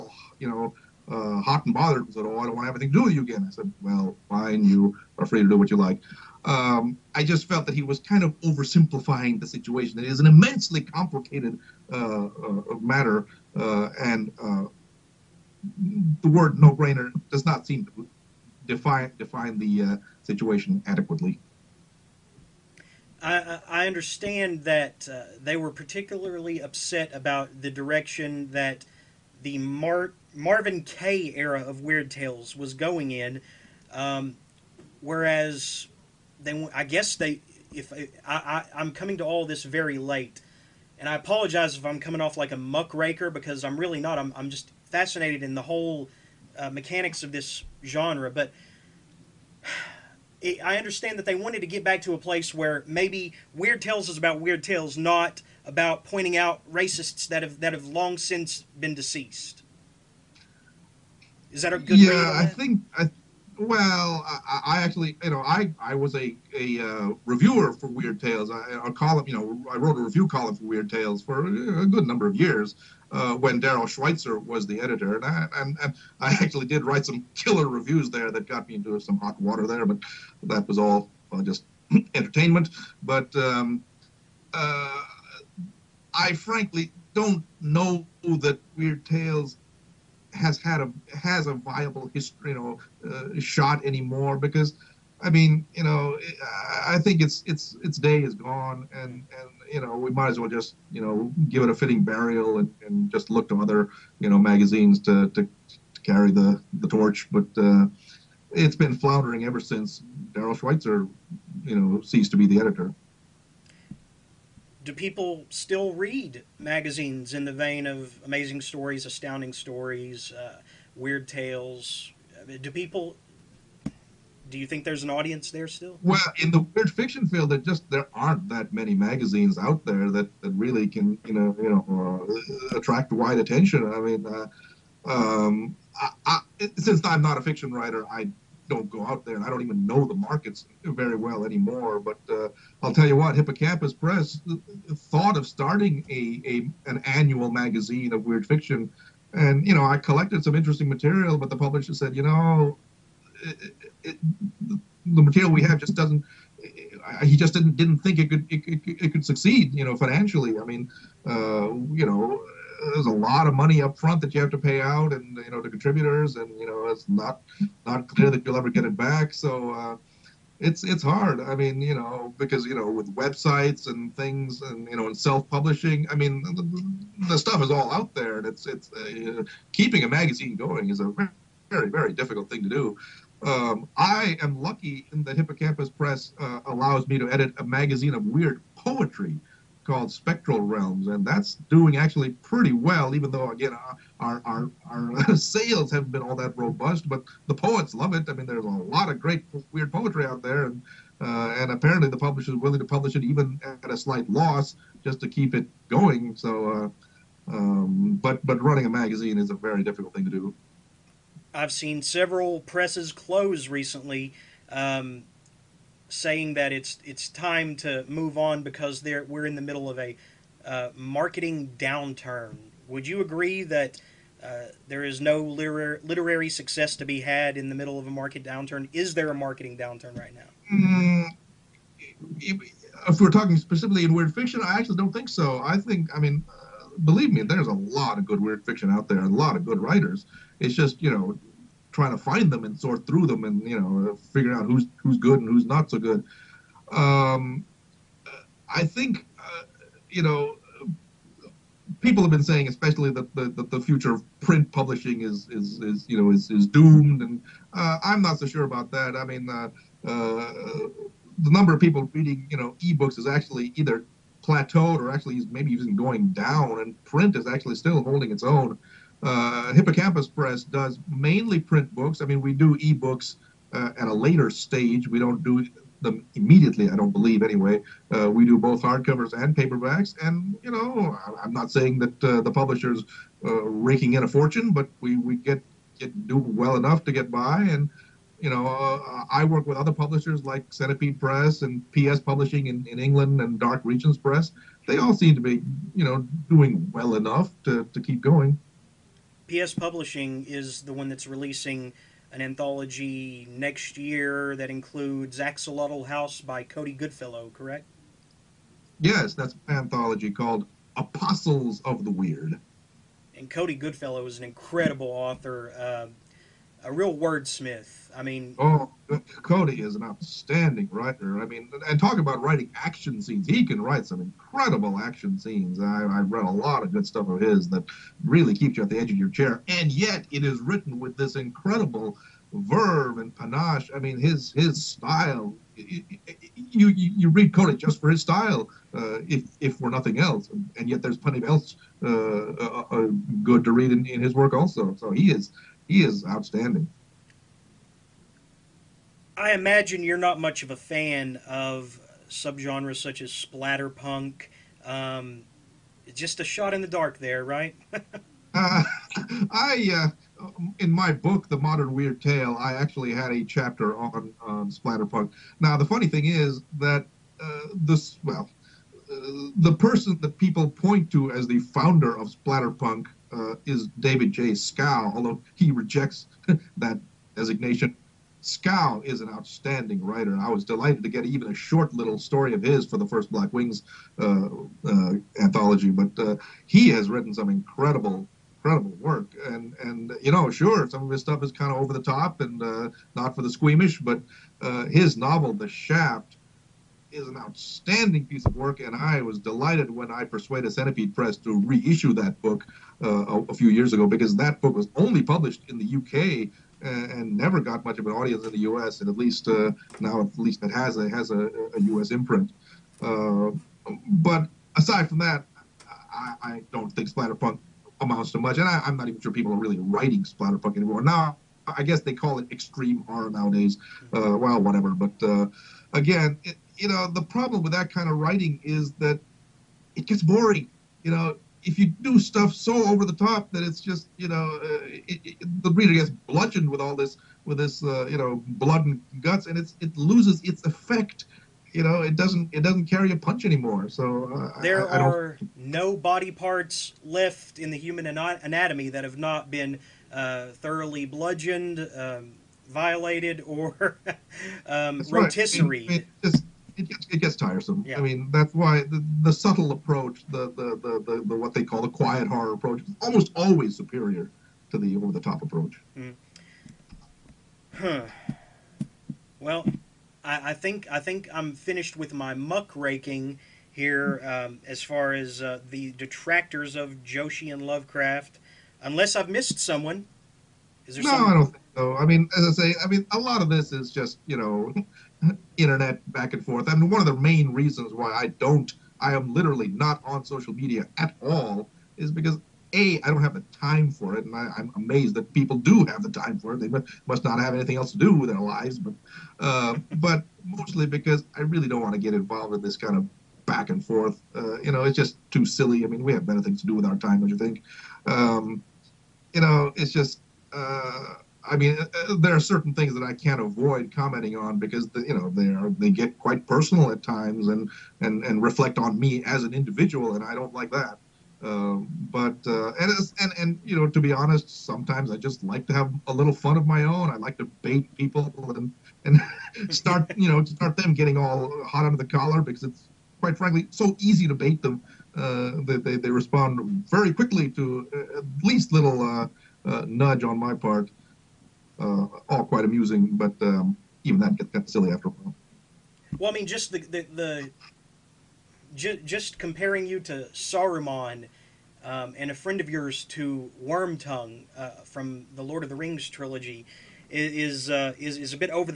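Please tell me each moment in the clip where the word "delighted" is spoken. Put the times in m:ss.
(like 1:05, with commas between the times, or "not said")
6:20, 6:39.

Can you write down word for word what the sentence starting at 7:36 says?
just it gets, it gets tiresome.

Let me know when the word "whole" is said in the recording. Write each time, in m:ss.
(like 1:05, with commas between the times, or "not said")
0:45.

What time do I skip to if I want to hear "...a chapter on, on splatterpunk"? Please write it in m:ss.
6:03.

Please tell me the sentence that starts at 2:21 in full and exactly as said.
But uh, I'll tell you what, Hippocampus Press uh, thought of starting a, a an annual magazine of weird fiction.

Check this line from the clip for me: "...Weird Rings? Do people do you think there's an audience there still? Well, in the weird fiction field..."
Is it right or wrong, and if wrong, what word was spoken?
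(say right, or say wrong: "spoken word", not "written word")
wrong: "Tales", not "Rings".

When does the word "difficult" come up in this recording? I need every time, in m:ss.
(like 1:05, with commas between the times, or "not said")
3:02, 3:29.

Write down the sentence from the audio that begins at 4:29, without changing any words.
Uh, Hippocampus Press does mainly print books.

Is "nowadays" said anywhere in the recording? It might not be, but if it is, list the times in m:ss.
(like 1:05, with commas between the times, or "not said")
7:03.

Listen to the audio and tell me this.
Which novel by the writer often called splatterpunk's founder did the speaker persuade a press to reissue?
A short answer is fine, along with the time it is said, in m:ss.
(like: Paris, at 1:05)
The Shaft, at 6:35.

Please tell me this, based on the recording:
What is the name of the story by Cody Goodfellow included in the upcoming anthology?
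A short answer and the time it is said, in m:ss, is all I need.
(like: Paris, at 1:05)
Axolotl House, at 5:05.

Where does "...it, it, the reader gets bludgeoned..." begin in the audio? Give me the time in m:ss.
7:14.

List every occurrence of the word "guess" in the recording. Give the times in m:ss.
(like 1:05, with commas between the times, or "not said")
0:36, 7:01.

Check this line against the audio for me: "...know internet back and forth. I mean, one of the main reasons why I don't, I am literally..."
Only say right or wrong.
right.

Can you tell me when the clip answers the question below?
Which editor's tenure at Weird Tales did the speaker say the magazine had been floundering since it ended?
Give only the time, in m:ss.
1:50.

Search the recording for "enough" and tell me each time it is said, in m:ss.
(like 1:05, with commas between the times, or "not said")
4:46, 4:57.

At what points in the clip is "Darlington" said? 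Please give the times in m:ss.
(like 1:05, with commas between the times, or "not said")
not said.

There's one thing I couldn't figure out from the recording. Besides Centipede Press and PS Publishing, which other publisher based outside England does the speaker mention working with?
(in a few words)
Dark Regions Press.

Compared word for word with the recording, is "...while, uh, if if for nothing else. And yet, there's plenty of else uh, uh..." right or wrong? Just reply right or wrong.
wrong.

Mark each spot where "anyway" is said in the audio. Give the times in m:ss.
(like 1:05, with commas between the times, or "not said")
4:37.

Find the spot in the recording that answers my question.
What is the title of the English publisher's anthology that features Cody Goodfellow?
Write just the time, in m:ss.
5:10.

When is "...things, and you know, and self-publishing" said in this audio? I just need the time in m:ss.
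2:54.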